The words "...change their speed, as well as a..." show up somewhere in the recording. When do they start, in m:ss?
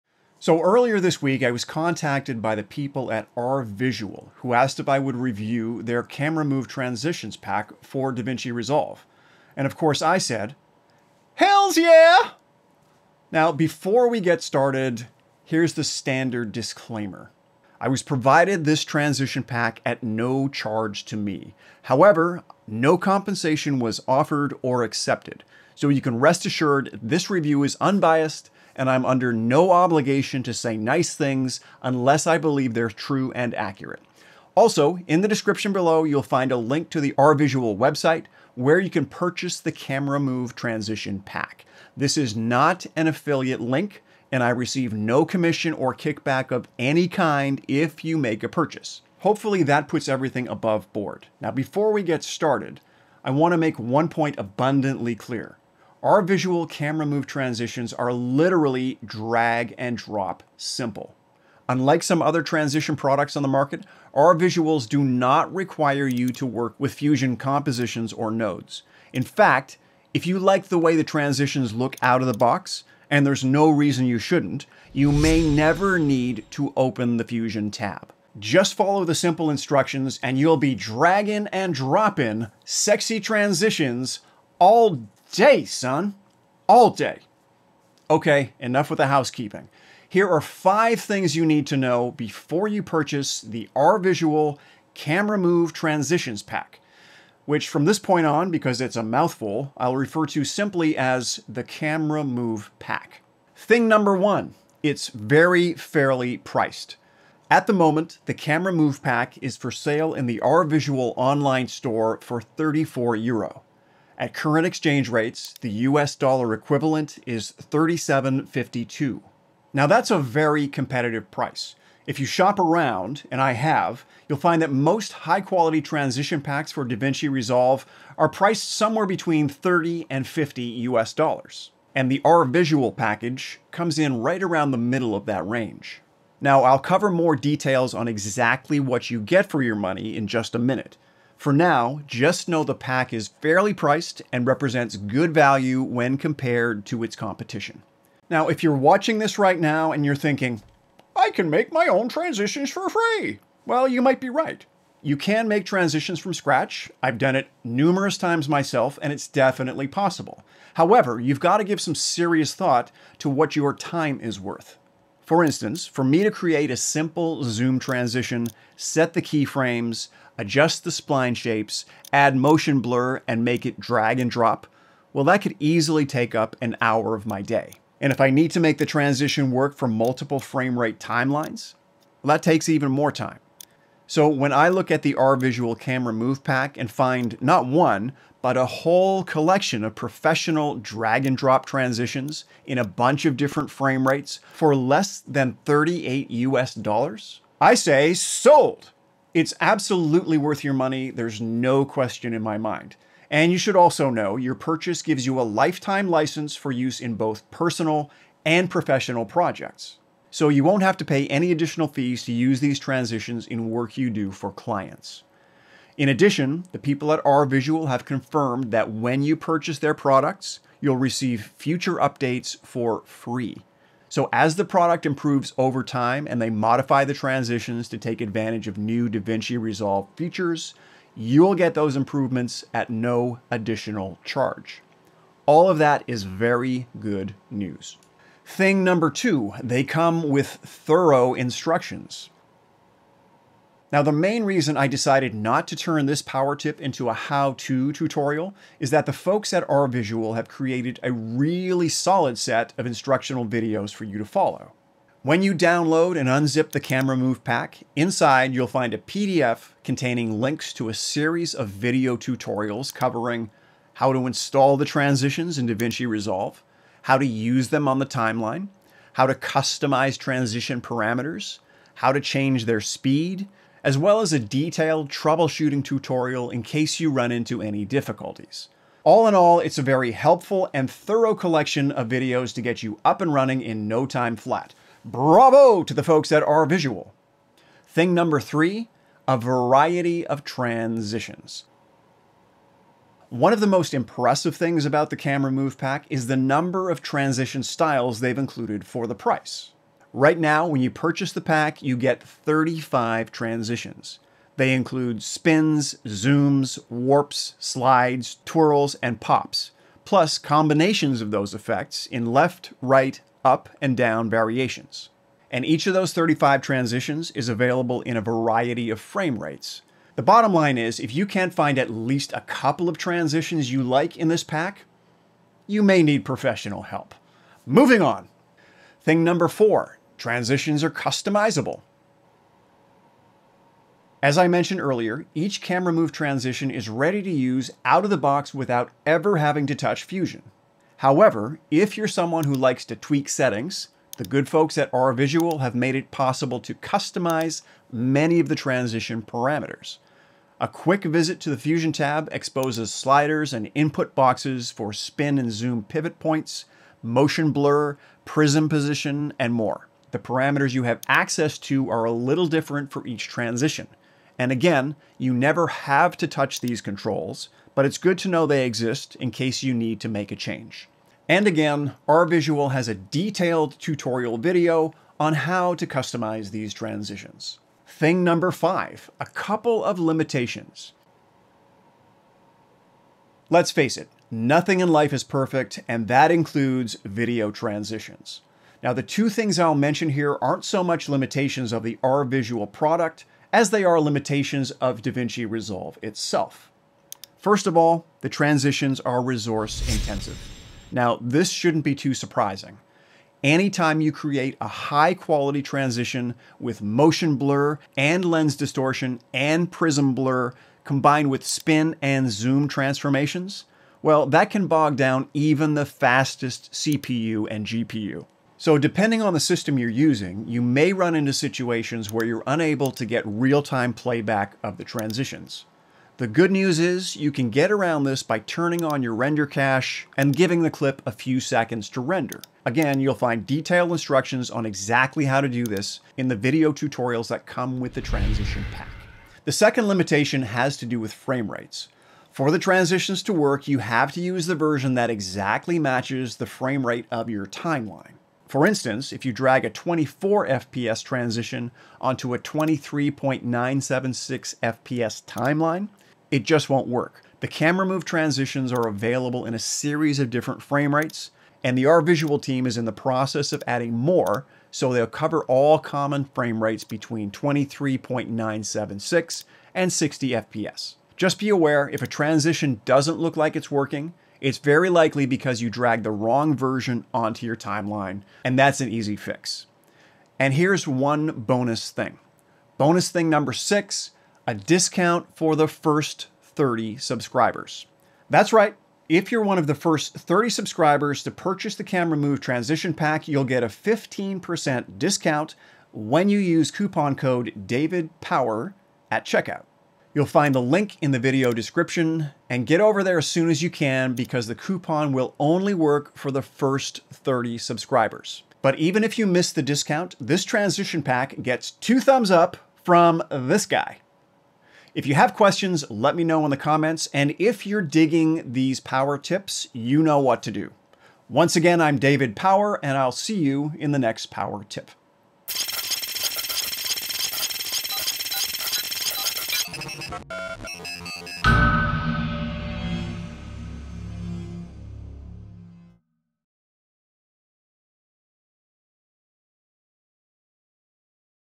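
4:32.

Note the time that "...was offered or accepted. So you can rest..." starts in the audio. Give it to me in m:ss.
0:23.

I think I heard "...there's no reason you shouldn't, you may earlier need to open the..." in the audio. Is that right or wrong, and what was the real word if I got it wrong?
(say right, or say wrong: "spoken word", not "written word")
wrong: "never", not "earlier".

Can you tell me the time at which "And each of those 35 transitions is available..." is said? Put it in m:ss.
5:15.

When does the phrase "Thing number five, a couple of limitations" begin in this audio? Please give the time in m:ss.
6:17.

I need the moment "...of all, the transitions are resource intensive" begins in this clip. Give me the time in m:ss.
6:37.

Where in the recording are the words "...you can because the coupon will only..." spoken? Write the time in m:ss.
8:23.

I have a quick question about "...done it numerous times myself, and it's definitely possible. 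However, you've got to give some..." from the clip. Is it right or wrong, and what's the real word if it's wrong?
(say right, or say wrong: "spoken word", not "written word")
right.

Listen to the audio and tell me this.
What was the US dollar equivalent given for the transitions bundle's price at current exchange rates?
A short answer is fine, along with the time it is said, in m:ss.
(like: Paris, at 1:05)
$37.52, at 1:57.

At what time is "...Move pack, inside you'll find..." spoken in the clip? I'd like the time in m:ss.
4:17.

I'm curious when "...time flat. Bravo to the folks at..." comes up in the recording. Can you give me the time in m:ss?
4:44.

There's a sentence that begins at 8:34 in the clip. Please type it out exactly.
If you have questions, let me know in the comments.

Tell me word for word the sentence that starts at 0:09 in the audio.
And of course, I said, Hells yeah!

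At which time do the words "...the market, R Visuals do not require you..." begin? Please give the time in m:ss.
1:03.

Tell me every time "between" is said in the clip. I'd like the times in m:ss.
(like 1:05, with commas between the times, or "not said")
2:09, 7:46.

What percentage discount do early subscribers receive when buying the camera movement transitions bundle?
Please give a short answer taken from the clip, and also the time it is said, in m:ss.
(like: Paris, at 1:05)
15%, at 8:13.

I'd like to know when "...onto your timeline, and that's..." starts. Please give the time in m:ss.
7:57.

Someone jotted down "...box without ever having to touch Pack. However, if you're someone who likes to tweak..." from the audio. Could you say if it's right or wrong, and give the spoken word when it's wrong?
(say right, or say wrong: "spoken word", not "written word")
wrong: "Fusion", not "Pack".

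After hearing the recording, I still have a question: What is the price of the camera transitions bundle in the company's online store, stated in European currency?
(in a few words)
34 euro.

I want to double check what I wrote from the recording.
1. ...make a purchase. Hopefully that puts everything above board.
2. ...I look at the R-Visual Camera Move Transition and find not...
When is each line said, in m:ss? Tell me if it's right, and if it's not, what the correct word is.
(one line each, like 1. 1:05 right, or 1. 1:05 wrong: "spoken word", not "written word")
1. 0:48 right
2. 3:04 wrong: "Pack", not "Transition".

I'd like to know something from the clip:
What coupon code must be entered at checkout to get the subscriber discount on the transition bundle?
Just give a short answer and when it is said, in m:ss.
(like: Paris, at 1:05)
DAVIDPOWER, at 8:17.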